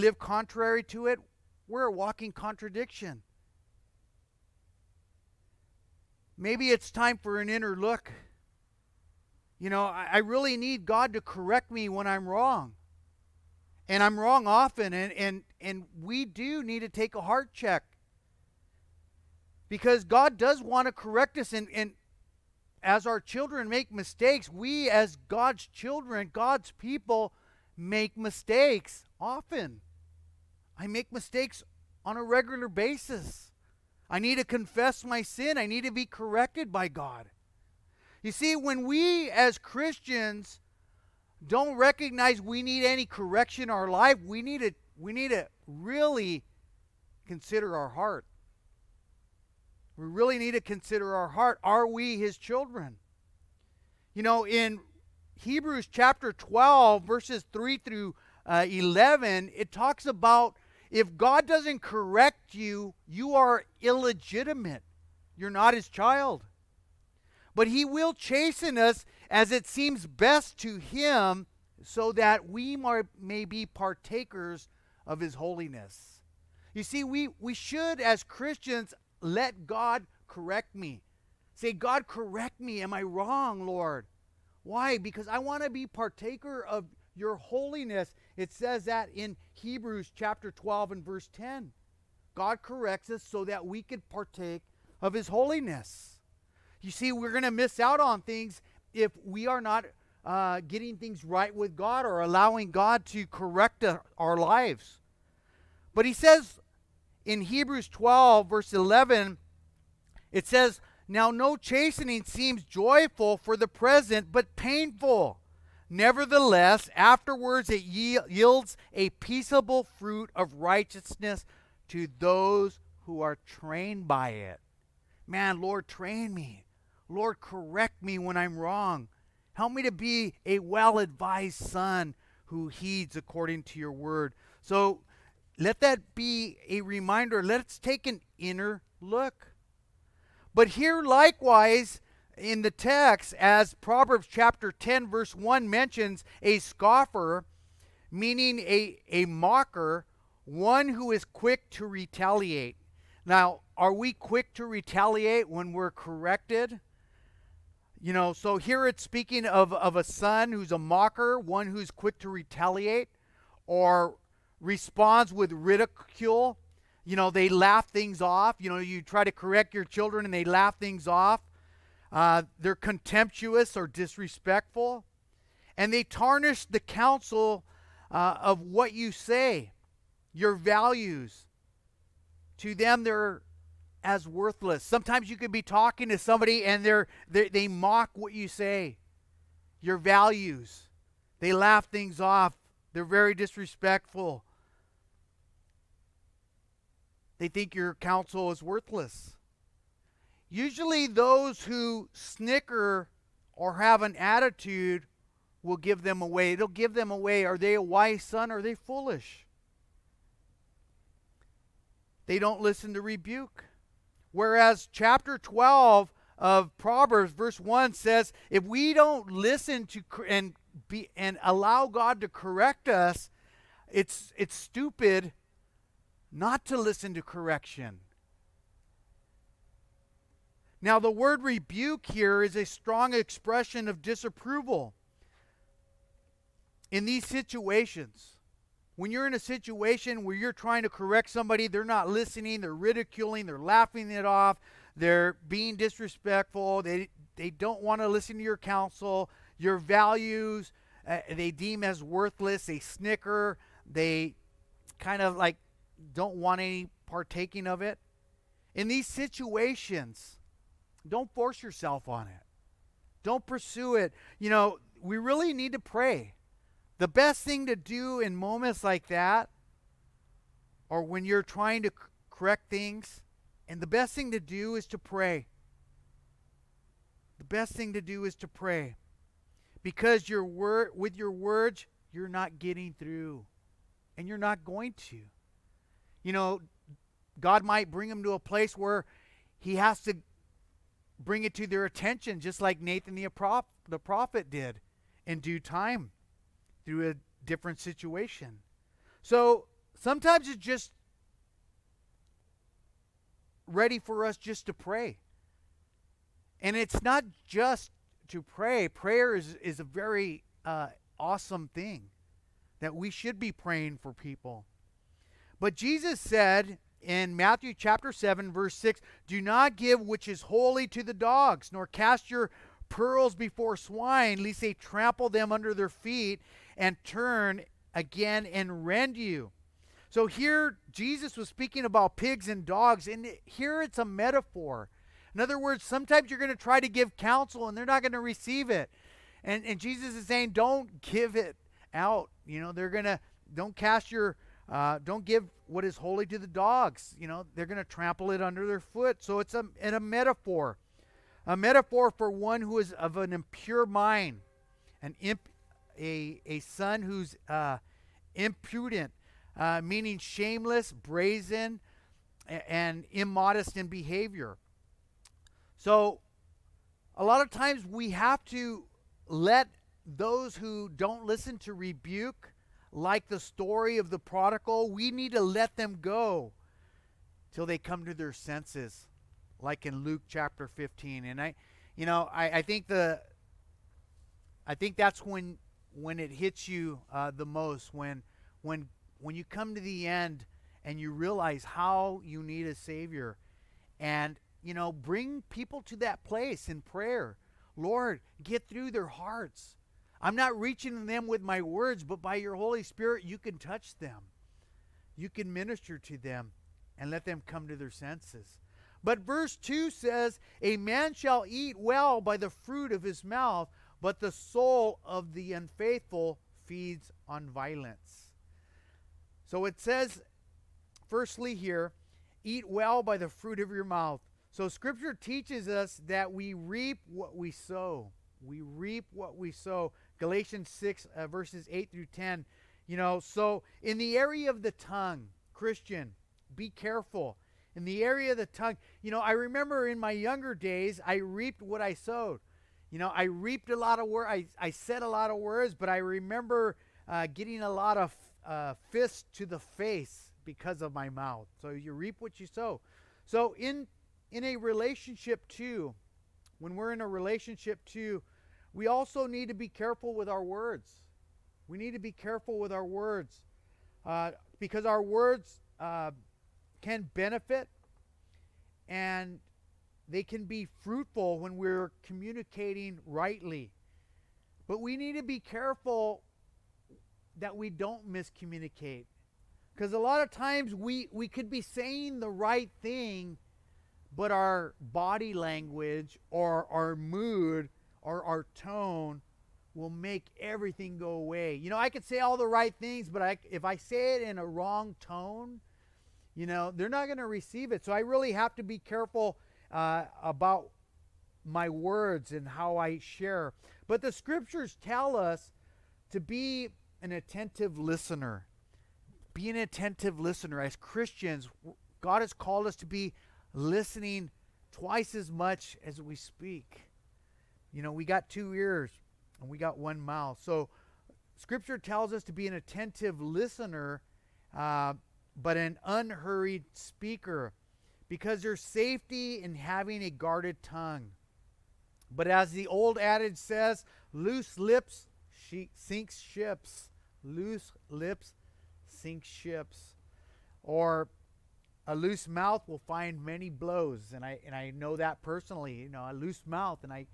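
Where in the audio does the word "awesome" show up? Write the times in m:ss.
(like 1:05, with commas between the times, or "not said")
5:11.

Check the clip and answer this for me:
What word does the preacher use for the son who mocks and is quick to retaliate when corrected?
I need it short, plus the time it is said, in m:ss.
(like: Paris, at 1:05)
scoffer, at 2:26.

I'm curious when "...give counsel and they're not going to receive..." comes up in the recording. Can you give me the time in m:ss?
5:36.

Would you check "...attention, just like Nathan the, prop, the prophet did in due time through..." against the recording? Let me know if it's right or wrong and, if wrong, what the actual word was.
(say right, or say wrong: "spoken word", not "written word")
right.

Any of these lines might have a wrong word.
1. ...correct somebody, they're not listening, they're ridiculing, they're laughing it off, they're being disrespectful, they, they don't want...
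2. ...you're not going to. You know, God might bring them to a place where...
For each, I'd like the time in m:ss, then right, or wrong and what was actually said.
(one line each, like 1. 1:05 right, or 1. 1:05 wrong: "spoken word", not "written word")
1. 4:00 right
2. 4:44 right.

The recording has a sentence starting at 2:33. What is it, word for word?
Now, are we quick to retaliate when we're corrected?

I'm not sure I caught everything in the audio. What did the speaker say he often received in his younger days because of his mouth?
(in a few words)
fists to the face.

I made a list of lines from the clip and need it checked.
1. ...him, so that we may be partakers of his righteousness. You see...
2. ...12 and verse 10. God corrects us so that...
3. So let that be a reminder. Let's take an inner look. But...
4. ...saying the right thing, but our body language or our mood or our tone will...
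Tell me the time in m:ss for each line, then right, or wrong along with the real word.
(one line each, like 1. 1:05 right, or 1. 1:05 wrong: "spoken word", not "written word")
1. 1:10 wrong: "holiness", not "righteousness"
2. 1:30 right
3. 2:14 right
4. 8:01 right.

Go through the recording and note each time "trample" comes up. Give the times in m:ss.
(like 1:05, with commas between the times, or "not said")
5:24, 5:47.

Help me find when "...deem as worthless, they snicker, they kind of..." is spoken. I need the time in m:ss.
4:11.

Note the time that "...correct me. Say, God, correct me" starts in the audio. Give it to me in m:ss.
1:20.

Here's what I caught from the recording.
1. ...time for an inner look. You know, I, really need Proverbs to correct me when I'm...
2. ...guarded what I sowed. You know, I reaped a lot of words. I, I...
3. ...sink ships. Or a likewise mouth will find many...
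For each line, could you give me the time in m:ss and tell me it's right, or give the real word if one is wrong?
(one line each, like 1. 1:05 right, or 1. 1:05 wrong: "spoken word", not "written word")
1. 0:06 wrong: "God", not "Proverbs"
2. 7:21 wrong: "reaped", not "guarded"
3. 8:58 wrong: "loose", not "likewise".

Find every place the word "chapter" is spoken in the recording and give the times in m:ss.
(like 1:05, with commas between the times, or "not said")
0:55, 1:30, 2:24, 3:34, 5:17, 6:20.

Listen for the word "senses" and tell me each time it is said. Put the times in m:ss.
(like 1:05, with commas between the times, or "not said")
6:18, 6:47.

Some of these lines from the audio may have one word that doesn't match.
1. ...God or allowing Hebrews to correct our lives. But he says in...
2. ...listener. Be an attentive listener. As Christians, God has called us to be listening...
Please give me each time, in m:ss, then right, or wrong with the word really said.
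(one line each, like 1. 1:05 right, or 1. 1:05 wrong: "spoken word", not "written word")
1. 1:41 wrong: "God", not "Hebrews"
2. 8:27 right.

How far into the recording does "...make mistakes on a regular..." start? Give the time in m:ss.
0:30.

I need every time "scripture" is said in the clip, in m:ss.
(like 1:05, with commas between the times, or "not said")
7:04, 8:24, 8:41.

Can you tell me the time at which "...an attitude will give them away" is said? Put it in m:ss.
3:24.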